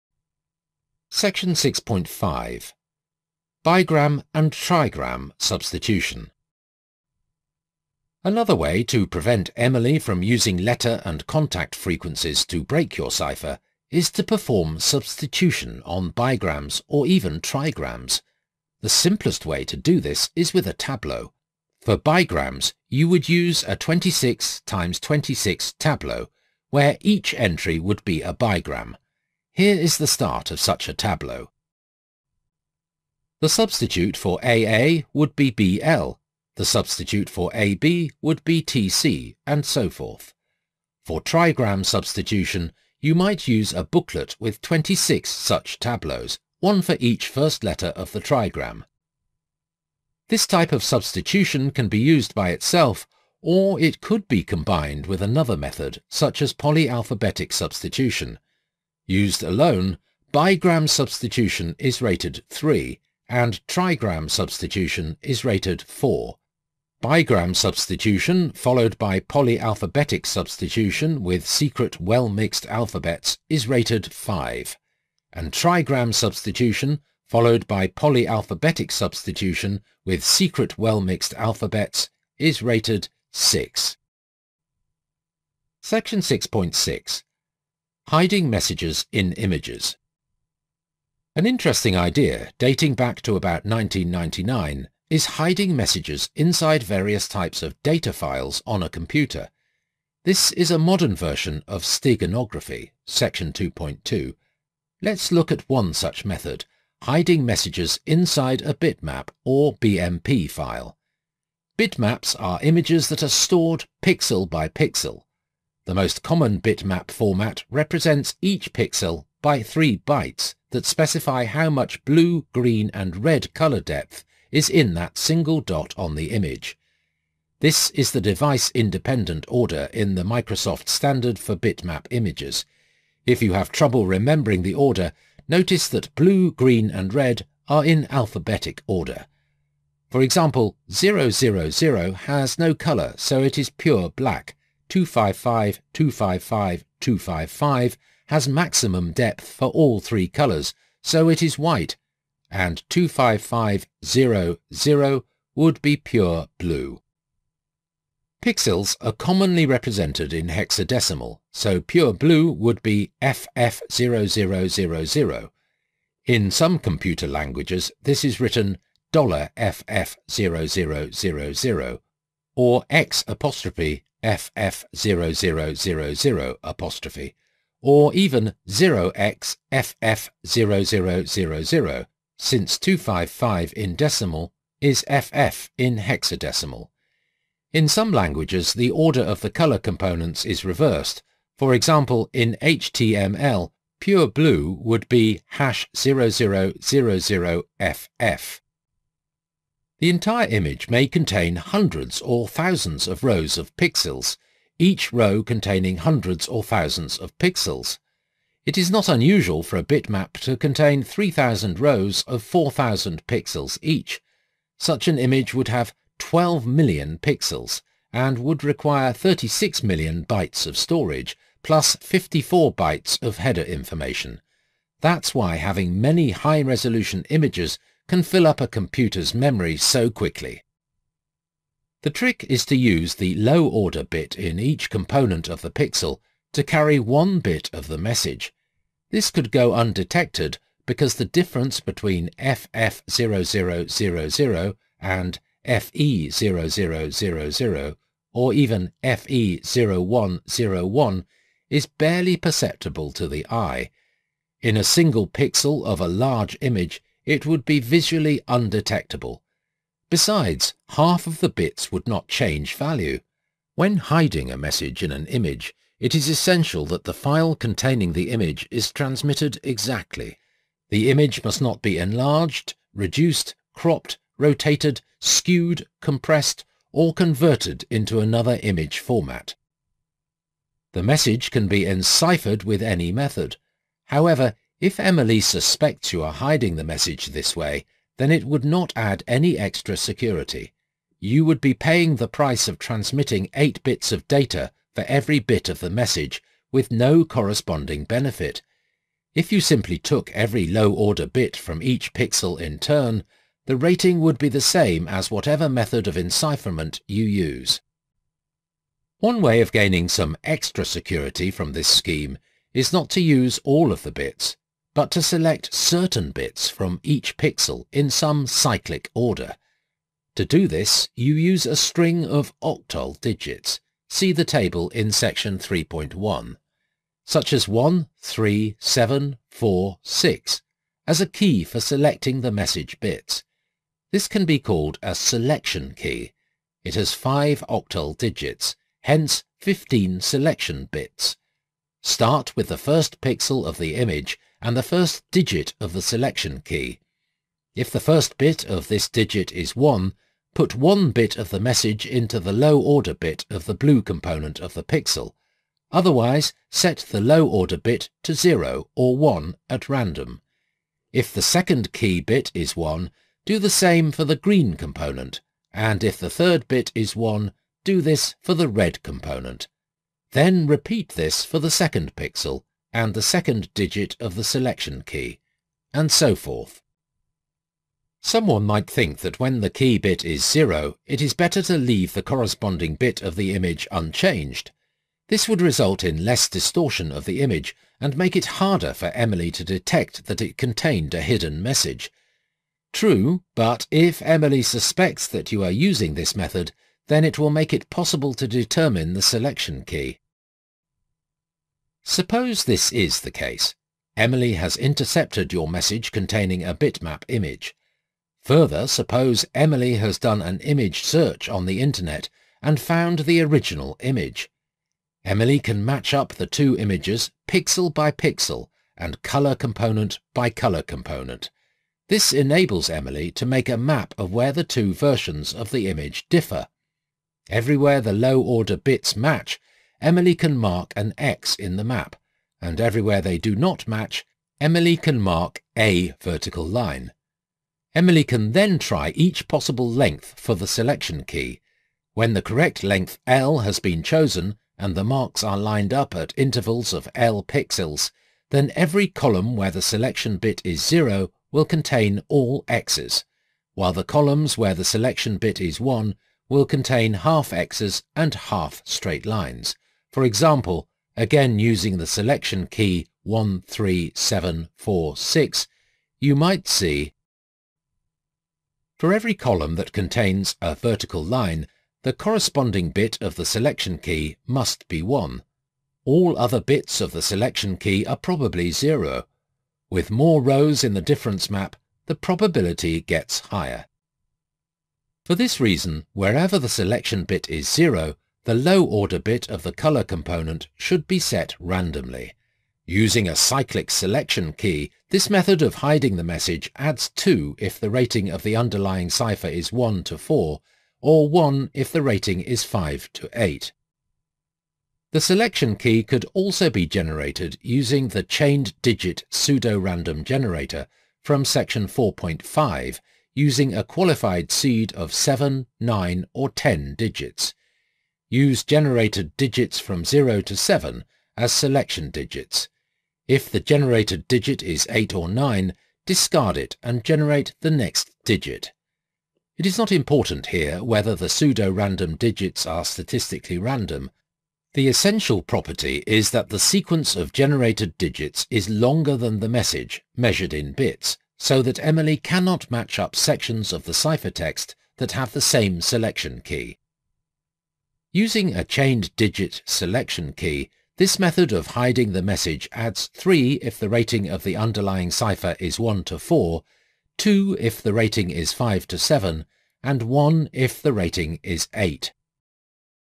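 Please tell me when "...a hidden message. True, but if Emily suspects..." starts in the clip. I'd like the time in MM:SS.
06:31.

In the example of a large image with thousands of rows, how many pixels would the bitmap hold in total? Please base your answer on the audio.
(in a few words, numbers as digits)
12 million.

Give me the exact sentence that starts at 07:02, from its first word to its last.
This enables Emily to make a map of where the two versions of the image differ.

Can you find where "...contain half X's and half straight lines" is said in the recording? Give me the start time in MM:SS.
07:36.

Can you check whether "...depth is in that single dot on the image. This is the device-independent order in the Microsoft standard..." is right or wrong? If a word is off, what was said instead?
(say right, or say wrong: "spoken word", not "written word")
right.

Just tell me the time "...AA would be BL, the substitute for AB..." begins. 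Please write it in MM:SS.
00:34.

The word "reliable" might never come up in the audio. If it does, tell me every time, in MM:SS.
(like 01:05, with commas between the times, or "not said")
not said.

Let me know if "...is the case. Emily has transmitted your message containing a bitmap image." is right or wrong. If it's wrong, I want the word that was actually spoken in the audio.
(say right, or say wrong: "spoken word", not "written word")
wrong: "intercepted", not "transmitted".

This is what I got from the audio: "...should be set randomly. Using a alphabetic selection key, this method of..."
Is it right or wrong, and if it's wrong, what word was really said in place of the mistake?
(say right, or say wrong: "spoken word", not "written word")
wrong: "cyclic", not "alphabetic".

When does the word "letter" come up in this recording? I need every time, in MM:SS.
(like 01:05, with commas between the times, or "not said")
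00:10, 00:47.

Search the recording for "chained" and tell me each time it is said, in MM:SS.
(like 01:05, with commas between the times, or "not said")
08:28, 09:08.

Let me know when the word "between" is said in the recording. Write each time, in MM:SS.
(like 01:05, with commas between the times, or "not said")
04:01.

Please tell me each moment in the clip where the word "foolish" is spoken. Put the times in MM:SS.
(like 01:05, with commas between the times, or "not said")
not said.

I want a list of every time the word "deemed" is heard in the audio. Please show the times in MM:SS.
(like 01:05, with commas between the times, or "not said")
not said.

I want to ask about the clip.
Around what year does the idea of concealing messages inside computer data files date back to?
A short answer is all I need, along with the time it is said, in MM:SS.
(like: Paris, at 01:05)
1999, at 01:33.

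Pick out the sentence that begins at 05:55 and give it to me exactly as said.
Otherwise, set the low order bit to 0 or 1 at random.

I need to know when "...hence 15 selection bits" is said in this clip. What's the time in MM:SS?
05:39.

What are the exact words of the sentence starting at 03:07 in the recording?
In some languages, the order of the color components is reversed.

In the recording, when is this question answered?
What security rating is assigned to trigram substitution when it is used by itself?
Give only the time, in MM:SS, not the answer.
01:03.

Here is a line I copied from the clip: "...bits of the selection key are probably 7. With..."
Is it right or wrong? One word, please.
wrong.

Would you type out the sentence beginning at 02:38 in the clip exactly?
Pixels are commonly represented in hexadecimal, so pure blue would be FF0000.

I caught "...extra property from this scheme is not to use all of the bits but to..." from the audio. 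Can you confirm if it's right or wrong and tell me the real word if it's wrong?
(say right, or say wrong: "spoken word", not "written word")
wrong: "security", not "property".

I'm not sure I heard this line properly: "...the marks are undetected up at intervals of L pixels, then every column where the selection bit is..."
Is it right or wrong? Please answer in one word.
wrong.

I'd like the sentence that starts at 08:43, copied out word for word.
If the generated digit is 8 or 9, discard it and generate the next digit.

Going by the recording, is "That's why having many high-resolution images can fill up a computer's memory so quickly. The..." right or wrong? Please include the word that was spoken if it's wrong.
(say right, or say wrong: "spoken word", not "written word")
right.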